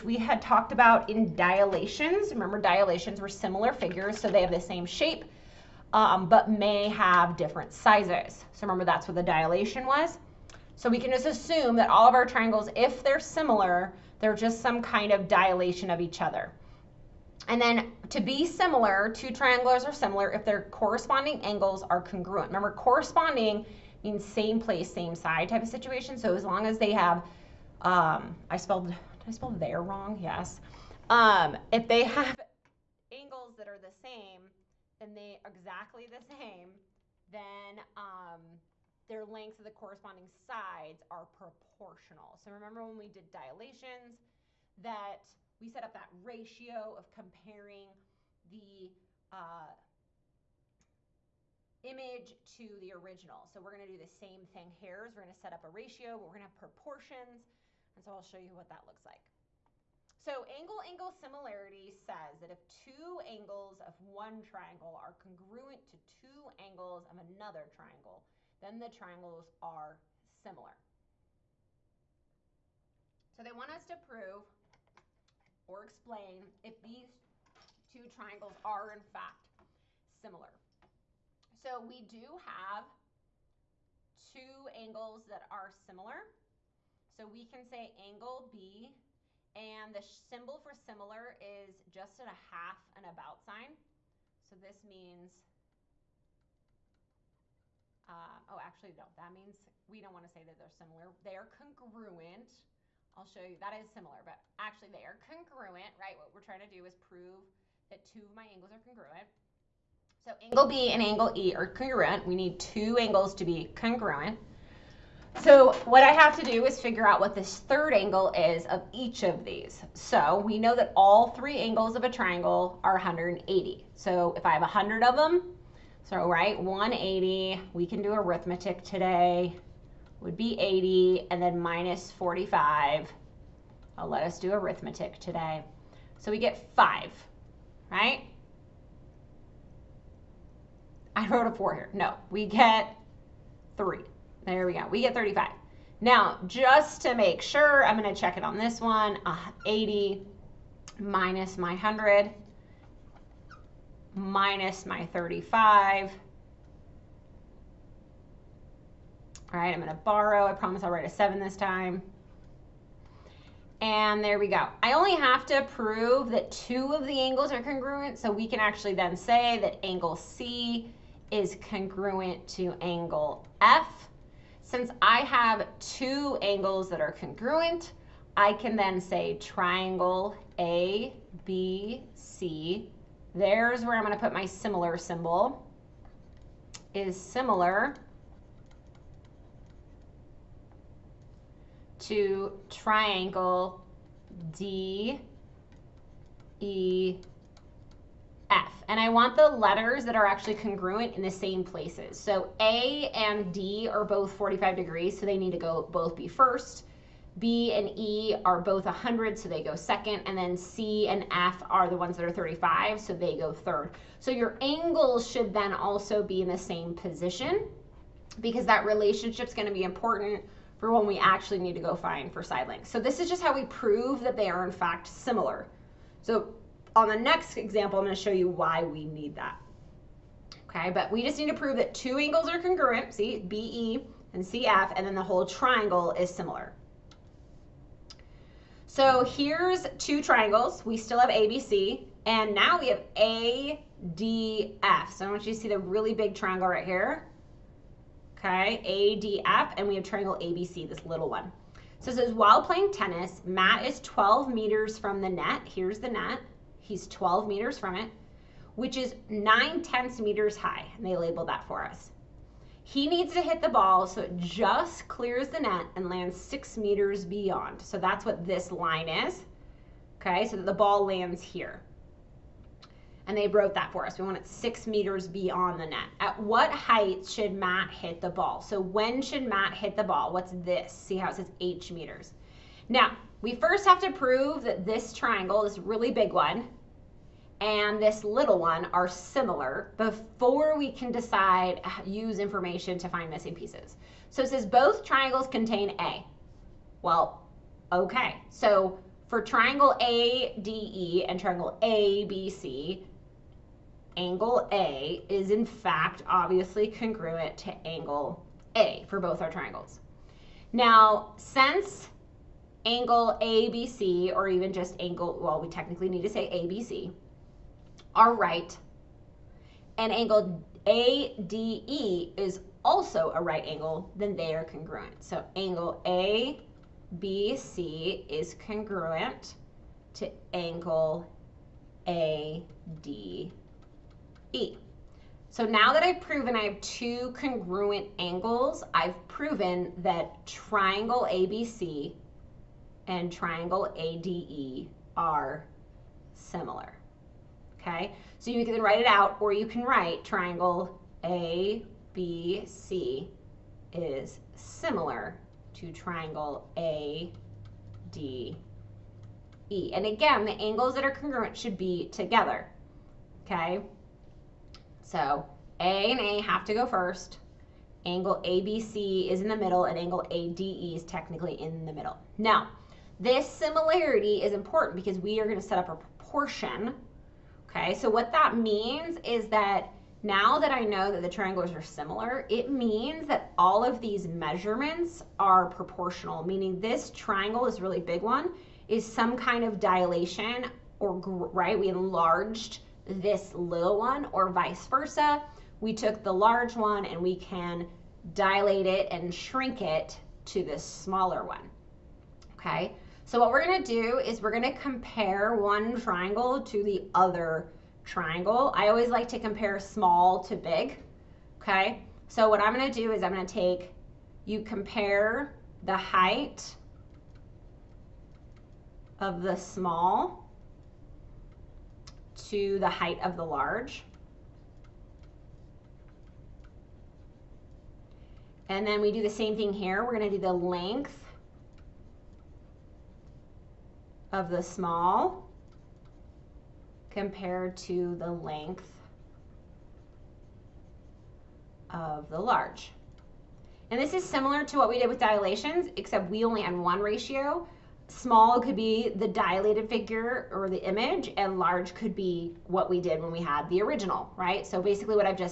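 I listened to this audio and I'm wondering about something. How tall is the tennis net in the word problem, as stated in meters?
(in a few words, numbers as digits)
9/10.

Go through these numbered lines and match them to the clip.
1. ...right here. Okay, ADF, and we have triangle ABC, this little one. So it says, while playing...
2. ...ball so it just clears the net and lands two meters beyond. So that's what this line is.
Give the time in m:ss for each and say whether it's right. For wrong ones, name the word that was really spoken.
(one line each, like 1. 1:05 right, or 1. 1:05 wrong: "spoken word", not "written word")
1. 4:06 right
2. 4:23 wrong: "six", not "two".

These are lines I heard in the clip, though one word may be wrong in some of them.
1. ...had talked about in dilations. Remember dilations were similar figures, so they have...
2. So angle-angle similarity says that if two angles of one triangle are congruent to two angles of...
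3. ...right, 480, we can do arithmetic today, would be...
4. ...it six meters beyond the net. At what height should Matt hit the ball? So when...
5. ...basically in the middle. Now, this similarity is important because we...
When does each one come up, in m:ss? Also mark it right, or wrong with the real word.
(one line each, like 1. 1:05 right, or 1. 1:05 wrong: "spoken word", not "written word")
1. 0:00 right
2. 1:00 right
3. 2:06 wrong: "180", not "480"
4. 4:34 right
5. 6:11 wrong: "technically", not "basically".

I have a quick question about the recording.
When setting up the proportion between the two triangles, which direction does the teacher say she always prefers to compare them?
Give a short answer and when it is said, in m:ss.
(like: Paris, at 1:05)
small to big, at 6:49.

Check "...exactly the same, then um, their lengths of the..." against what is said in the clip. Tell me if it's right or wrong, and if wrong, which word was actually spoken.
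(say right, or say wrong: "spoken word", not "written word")
right.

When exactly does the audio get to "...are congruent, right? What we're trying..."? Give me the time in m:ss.
1:45.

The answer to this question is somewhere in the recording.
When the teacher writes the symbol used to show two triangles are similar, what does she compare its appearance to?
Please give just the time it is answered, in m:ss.
1:32.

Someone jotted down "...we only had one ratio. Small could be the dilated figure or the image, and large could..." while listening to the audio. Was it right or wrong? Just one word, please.
right.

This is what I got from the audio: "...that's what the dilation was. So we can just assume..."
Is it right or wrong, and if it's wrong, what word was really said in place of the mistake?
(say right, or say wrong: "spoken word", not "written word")
right.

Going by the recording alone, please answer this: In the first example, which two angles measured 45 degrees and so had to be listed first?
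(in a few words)
A and D.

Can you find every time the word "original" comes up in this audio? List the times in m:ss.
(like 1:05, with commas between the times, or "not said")
0:52, 7:33.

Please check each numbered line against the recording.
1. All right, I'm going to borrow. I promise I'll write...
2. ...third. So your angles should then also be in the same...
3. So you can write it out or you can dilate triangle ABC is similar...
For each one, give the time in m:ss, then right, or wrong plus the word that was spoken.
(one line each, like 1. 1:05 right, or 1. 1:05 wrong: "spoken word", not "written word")
1. 2:39 right
2. 3:33 right
3. 5:48 wrong: "write", not "dilate".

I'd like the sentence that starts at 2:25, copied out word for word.
Now, just to make sure, I'm going to check it on this one.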